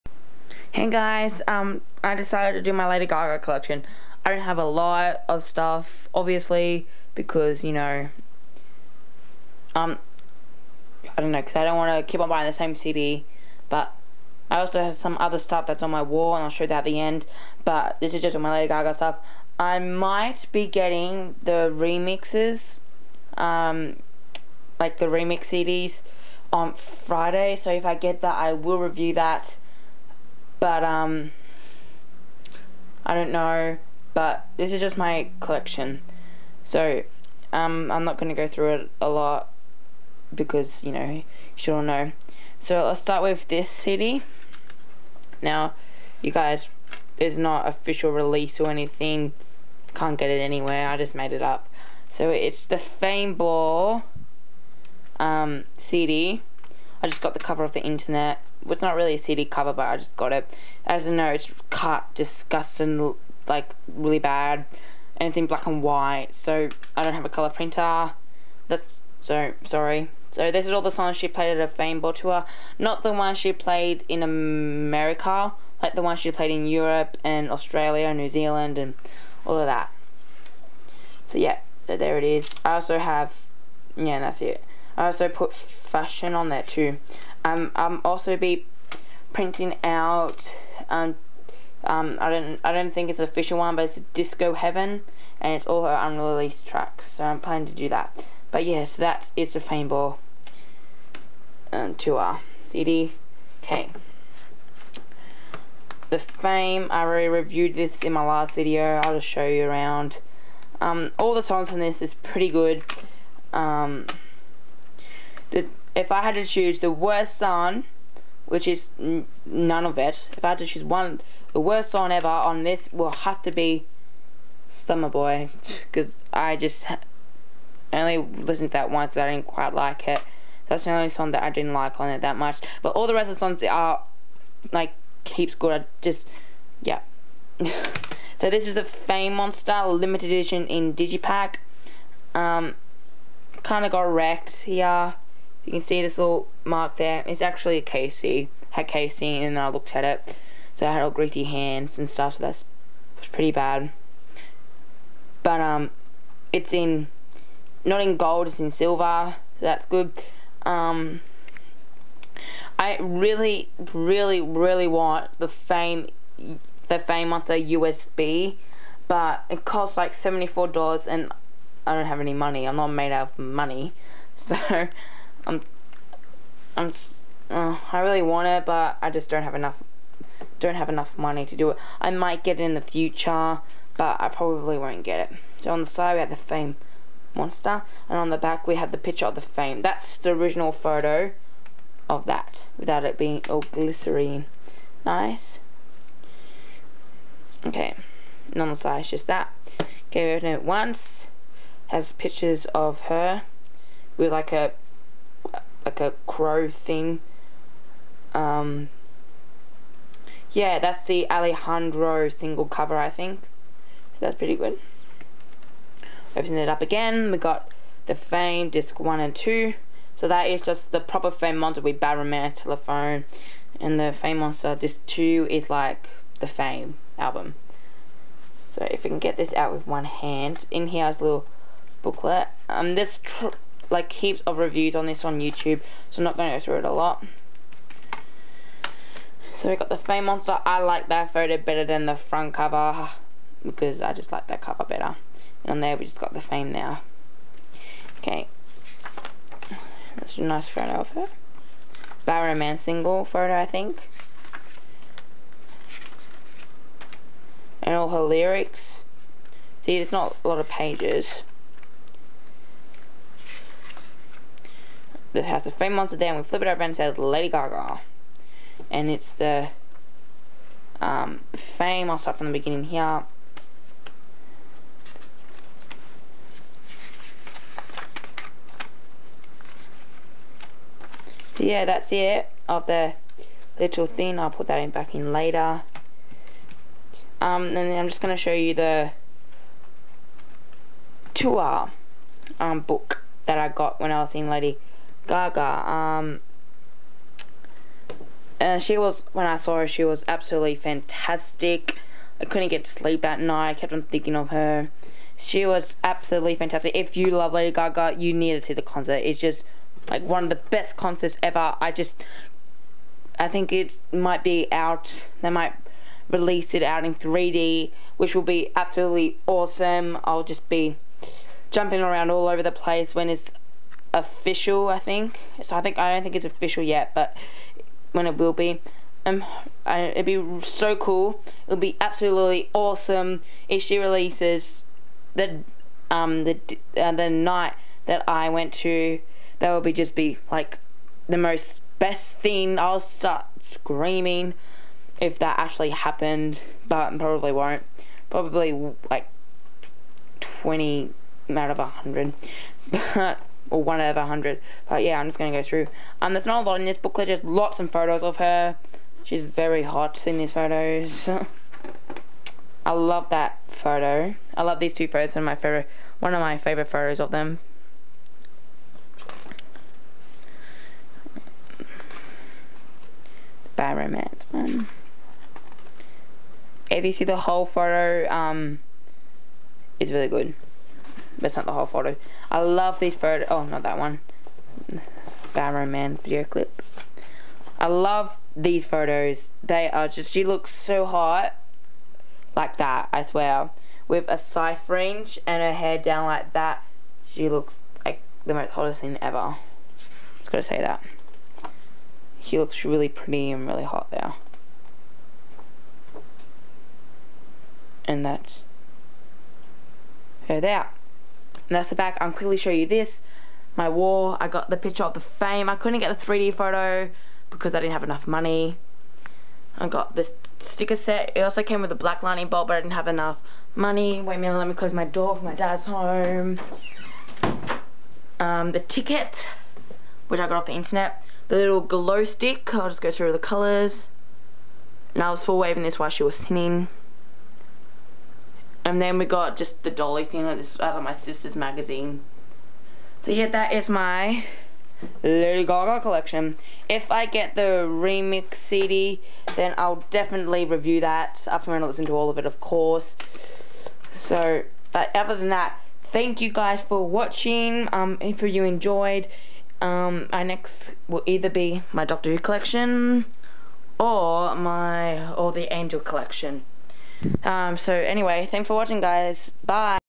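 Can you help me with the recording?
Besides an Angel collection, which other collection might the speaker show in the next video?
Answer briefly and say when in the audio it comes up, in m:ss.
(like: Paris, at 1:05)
Doctor Who, at 7:42.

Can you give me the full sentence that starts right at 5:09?
It's just like one of the best concerts ever.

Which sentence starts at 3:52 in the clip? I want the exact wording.
Um, this like heaps of reviews on this on YouTube, so I'm not going to go through it a lot.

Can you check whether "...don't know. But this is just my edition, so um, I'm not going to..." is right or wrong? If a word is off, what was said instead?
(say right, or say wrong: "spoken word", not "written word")
wrong: "collection", not "edition".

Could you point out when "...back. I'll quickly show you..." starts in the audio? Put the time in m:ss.
6:51.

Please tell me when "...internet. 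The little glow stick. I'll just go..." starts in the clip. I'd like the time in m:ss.
7:10.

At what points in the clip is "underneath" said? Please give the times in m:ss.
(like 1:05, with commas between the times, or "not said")
not said.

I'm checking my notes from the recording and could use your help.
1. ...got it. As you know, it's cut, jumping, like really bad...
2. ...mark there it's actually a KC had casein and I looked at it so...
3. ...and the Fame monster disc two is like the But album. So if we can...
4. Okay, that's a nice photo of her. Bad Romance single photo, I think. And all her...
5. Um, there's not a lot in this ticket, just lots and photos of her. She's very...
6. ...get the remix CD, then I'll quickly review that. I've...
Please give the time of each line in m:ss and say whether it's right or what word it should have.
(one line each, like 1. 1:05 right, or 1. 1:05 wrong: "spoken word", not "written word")
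1. 1:00 wrong: "disgusting", not "jumping"
2. 2:26 right
3. 3:43 wrong: "Fame", not "But"
4. 4:08 right
5. 5:56 wrong: "booklet", not "ticket"
6. 7:27 wrong: "definitely", not "quickly".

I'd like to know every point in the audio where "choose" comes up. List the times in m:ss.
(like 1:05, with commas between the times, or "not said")
1:56, 2:00.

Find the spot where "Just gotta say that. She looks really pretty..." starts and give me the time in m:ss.
6:40.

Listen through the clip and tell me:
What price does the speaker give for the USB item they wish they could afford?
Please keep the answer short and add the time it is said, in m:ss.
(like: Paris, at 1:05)
$74, at 2:50.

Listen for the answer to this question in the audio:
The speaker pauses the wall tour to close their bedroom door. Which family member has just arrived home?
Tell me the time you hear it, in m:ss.
7:05.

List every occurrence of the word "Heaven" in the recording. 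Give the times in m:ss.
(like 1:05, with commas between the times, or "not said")
1:34.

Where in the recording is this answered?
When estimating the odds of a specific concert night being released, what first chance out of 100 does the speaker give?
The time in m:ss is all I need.
5:50.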